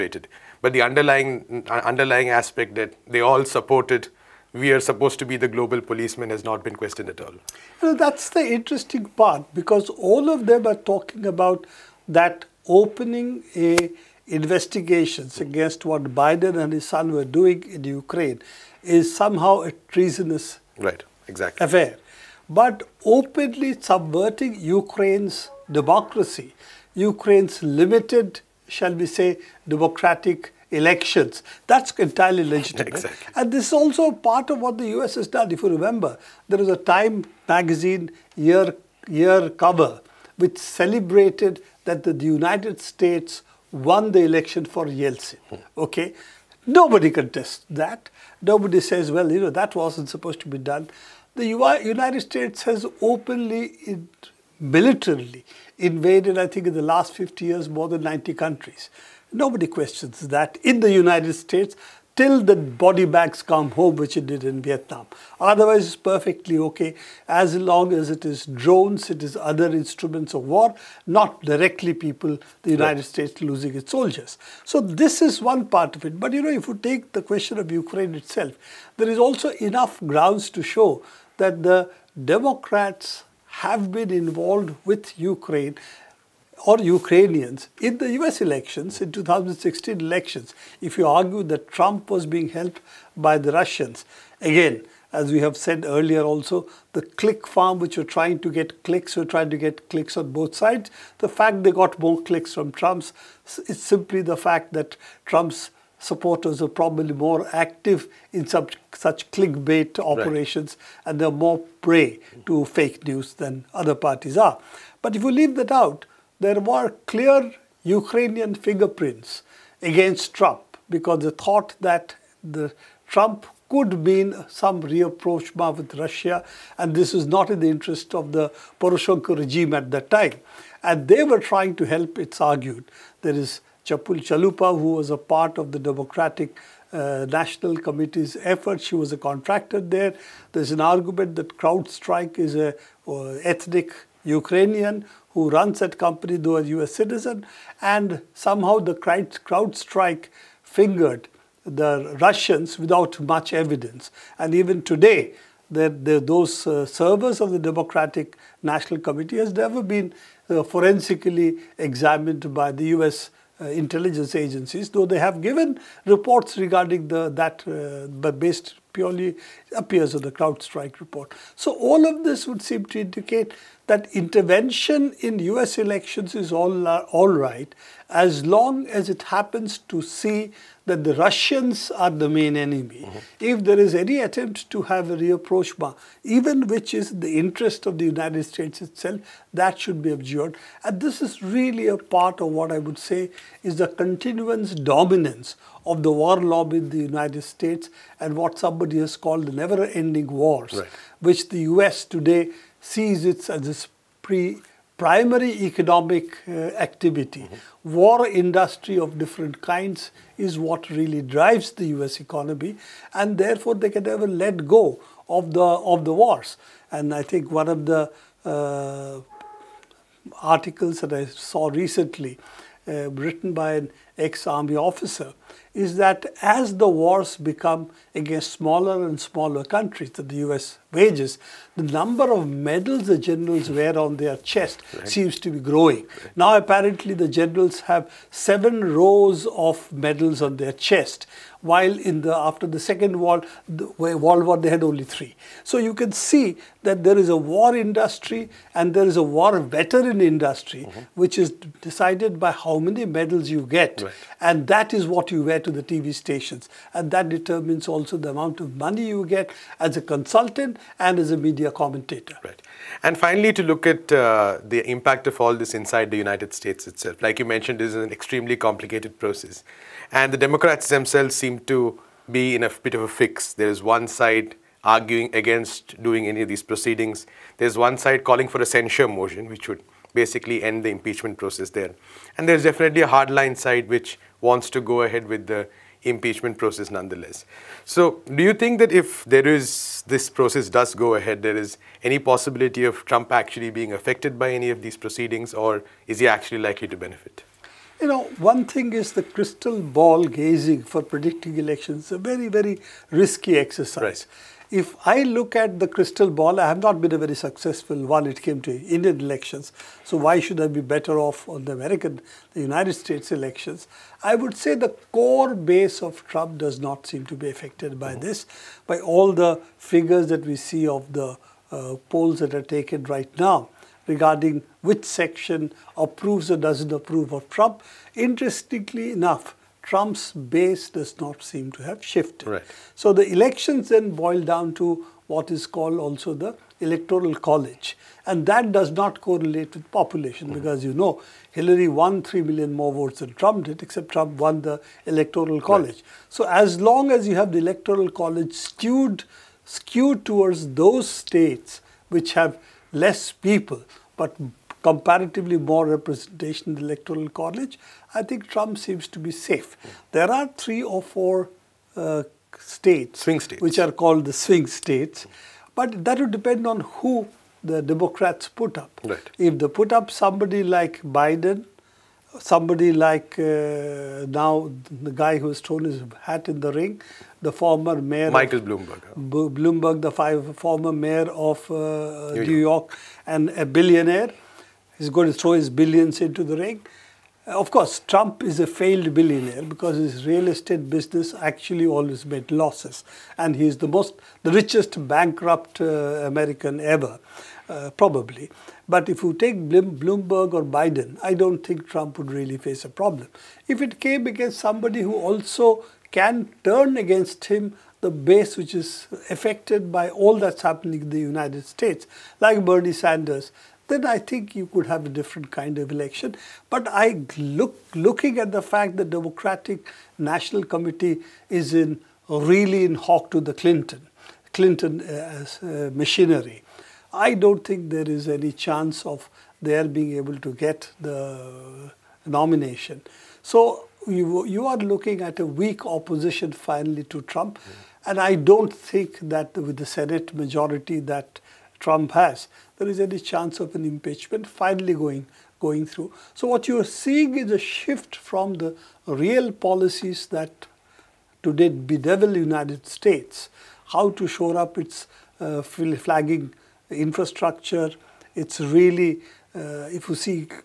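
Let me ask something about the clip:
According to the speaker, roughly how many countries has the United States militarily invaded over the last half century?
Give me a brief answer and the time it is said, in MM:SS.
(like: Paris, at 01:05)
more than 90, at 00:57.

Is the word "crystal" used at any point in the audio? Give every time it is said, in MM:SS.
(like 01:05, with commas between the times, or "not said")
04:59, 05:05.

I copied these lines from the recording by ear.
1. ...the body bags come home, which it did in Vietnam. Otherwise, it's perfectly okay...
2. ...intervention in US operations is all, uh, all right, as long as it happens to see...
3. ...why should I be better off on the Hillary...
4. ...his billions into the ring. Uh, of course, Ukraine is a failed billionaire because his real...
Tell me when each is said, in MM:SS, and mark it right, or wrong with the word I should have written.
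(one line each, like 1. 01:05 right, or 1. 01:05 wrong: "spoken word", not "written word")
1. 01:02 right
2. 02:54 wrong: "elections", not "operations"
3. 05:10 wrong: "American", not "Hillary"
4. 06:25 wrong: "Trump", not "Ukraine".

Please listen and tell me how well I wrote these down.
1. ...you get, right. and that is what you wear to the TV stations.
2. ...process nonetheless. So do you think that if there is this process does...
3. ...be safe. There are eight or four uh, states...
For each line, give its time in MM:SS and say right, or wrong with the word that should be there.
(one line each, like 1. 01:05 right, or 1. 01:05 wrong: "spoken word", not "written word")
1. 04:13 right
2. 04:46 right
3. 05:59 wrong: "three", not "eight".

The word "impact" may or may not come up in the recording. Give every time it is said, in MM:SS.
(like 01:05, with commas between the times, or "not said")
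04:24.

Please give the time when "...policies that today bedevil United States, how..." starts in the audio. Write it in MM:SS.
07:29.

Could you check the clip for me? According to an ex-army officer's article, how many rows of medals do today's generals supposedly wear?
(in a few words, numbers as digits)
7.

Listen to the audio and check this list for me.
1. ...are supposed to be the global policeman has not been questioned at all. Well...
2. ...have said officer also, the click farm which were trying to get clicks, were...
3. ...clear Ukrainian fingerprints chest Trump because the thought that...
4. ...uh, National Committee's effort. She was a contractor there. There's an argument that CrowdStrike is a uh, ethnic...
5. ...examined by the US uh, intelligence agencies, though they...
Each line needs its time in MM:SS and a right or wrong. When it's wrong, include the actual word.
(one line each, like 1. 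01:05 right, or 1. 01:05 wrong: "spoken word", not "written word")
1. 00:04 right
2. 01:35 wrong: "earlier", not "officer"
3. 01:57 wrong: "against", not "chest"
4. 02:16 right
5. 02:41 right.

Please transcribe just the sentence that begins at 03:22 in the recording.
today sees it as its pre- primary economic uh, activity.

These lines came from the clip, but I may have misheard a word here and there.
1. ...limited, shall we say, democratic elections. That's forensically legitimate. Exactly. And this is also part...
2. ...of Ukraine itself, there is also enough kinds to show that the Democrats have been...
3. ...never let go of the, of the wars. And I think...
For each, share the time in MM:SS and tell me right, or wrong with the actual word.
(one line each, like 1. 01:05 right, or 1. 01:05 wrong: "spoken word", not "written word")
1. 00:27 wrong: "entirely", not "forensically"
2. 01:17 wrong: "grounds", not "kinds"
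3. 03:34 right.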